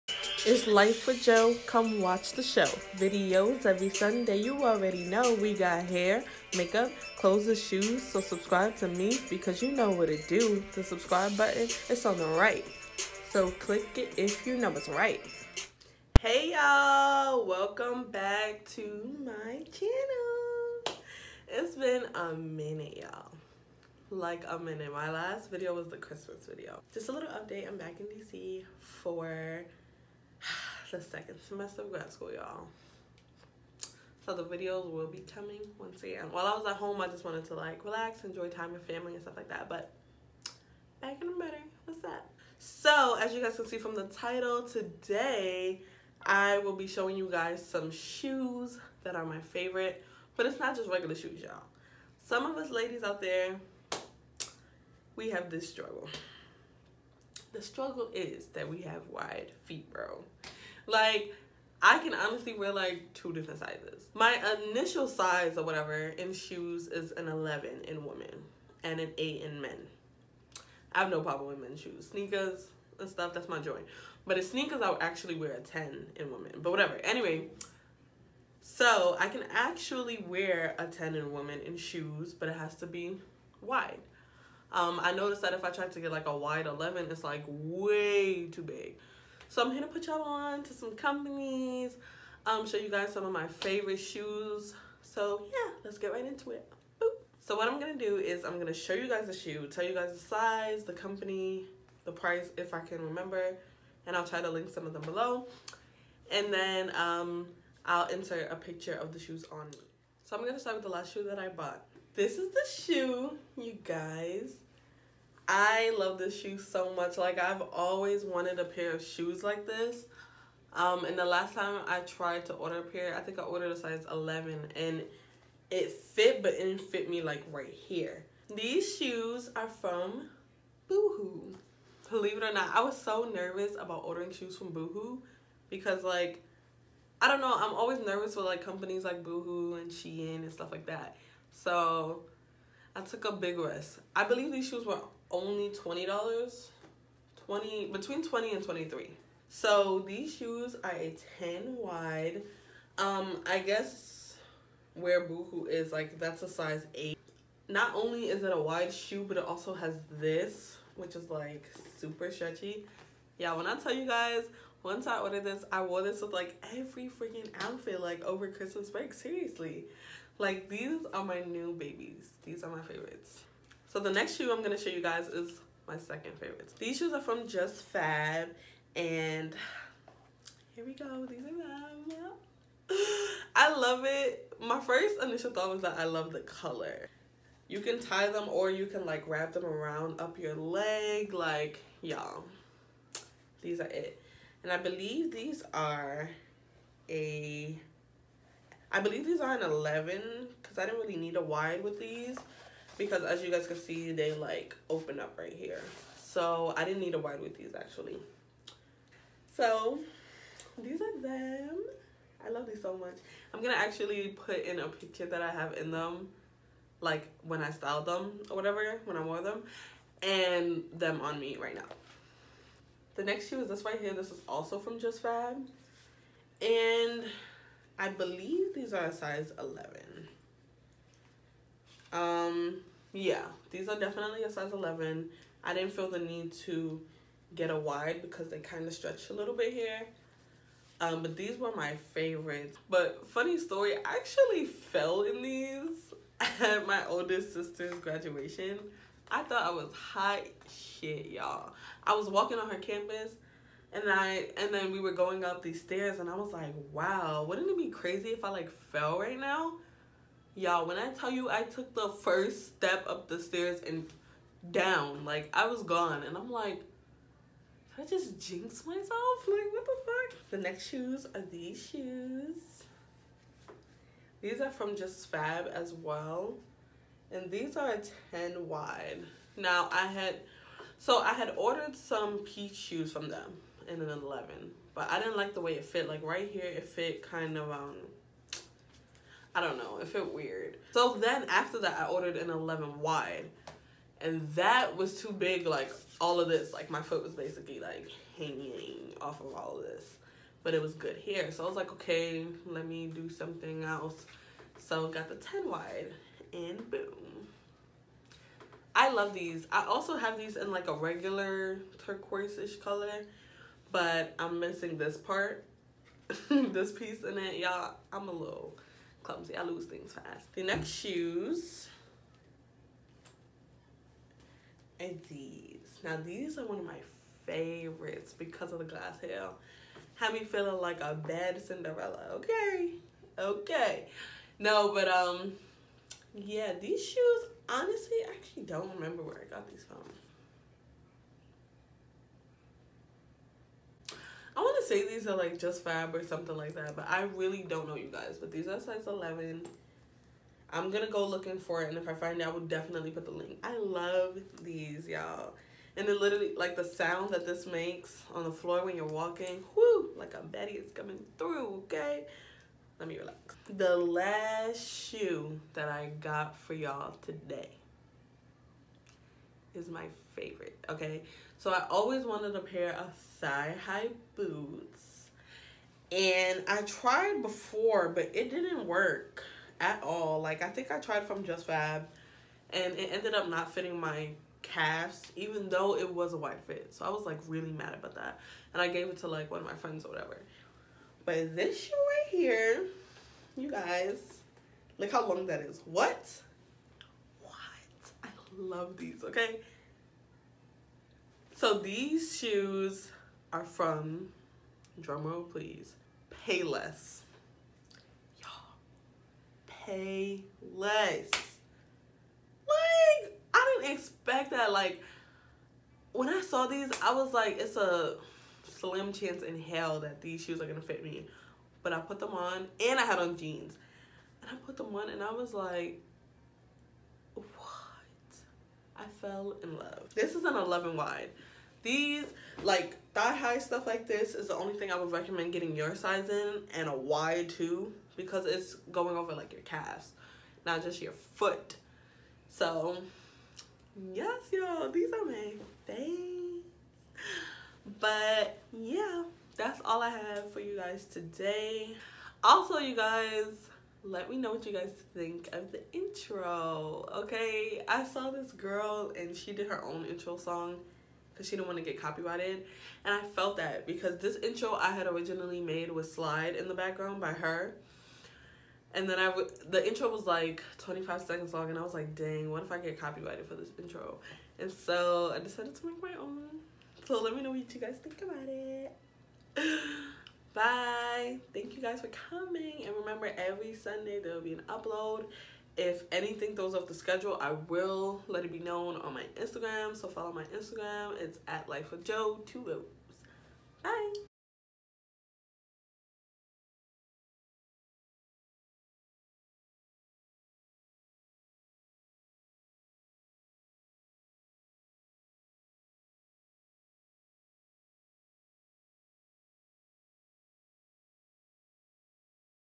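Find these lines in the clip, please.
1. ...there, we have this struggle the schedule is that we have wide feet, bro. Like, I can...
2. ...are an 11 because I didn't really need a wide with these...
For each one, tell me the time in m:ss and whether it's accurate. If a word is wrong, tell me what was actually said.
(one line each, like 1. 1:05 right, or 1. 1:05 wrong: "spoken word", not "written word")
1. 0:53 wrong: "struggle", not "schedule"
2. 3:19 right.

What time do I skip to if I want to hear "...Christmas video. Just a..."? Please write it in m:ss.
0:25.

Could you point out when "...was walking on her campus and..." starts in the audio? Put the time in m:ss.
4:12.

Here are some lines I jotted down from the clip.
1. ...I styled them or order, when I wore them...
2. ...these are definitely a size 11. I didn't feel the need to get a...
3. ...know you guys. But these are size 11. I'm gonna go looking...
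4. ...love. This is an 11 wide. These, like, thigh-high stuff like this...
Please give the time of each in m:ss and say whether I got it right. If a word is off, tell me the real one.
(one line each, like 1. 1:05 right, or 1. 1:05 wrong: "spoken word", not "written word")
1. 3:37 wrong: "whatever", not "order"
2. 3:53 right
3. 5:47 right
4. 7:09 right.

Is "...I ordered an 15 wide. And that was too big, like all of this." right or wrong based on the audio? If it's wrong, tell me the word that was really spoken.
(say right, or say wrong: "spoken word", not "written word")
wrong: "11", not "15".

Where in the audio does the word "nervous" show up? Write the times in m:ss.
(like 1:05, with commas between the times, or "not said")
2:13, 2:17.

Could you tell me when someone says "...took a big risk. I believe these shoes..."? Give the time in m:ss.
2:23.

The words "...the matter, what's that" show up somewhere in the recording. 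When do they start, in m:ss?
0:41.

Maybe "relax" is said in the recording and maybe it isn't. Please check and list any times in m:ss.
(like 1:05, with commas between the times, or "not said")
0:37, 6:03.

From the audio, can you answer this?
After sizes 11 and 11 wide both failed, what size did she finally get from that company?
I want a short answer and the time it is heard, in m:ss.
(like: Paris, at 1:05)
10 wide, at 5:04.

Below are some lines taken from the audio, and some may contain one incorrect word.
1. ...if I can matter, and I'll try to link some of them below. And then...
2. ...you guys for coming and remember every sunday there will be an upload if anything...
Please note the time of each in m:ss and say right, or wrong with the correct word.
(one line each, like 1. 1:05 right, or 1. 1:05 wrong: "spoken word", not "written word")
1. 1:42 wrong: "remember", not "matter"
2. 8:01 right.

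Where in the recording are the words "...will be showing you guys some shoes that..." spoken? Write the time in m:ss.
0:46.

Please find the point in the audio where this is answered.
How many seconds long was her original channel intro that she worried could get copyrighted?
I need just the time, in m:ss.
7:50.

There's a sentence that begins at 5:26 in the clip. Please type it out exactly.
Now these are one of my favorites because of the glass heel.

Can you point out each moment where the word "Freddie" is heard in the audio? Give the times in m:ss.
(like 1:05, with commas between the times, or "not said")
not said.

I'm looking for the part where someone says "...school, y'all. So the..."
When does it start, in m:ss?
0:32.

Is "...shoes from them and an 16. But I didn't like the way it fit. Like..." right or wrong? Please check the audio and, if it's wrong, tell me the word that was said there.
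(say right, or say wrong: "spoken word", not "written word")
wrong: "11", not "16".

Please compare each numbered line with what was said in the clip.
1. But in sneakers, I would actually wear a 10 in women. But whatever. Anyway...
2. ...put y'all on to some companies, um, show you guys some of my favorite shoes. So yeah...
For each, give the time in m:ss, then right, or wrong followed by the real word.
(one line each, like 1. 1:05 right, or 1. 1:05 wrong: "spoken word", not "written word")
1. 1:14 right
2. 1:29 right.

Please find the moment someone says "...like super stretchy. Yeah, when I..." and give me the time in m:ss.
2:41.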